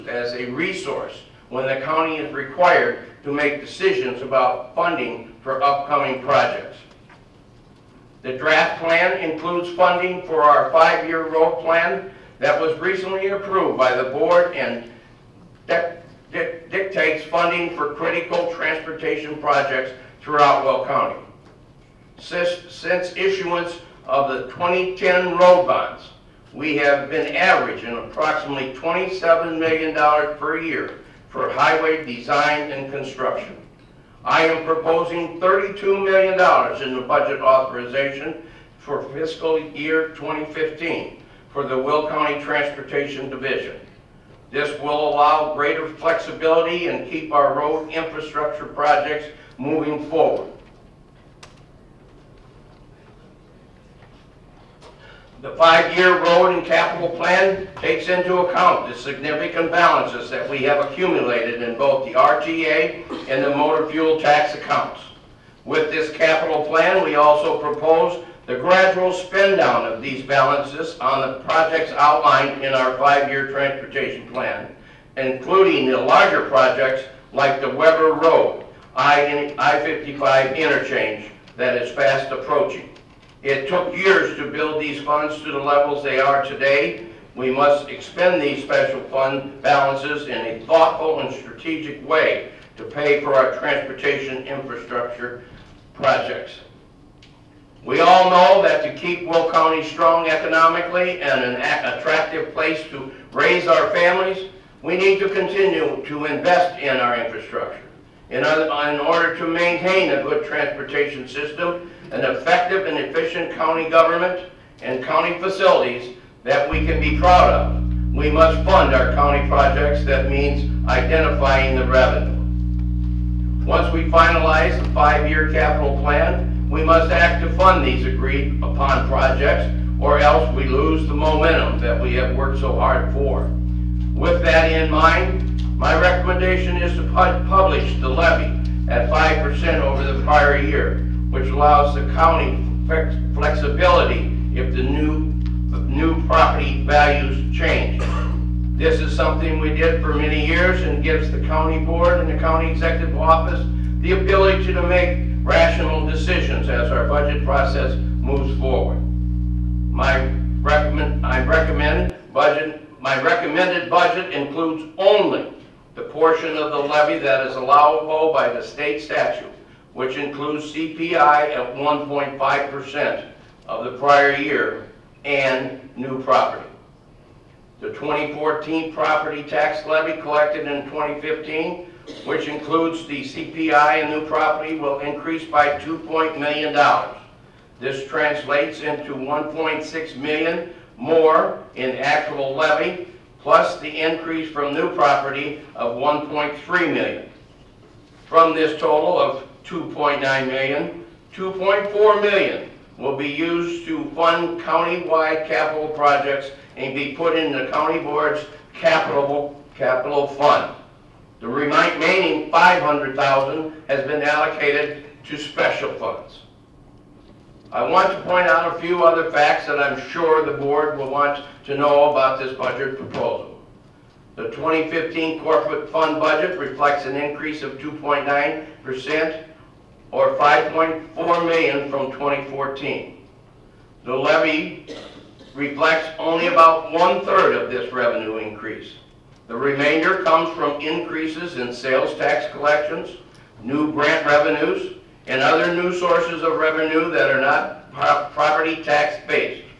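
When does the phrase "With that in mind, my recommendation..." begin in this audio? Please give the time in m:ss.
2:14.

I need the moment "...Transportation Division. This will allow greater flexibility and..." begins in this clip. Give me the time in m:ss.
0:42.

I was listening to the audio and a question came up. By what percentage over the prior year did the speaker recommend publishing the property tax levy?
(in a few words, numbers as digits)
5%.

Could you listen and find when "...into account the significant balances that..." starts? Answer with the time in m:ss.
0:58.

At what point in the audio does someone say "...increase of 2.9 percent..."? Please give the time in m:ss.
3:47.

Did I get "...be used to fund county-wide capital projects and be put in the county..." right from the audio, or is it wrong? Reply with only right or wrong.
right.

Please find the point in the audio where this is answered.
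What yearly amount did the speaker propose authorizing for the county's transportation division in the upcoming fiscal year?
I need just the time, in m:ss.
0:35.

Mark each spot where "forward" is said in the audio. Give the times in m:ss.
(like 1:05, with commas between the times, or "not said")
0:50, 2:38.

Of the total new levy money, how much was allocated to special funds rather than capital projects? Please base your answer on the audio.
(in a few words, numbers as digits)
500,000.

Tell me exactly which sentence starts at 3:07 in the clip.
This translates into 1.6 million more in actual levy, plus the increase from new property of 1.3 million.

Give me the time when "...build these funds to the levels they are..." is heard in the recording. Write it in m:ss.
1:24.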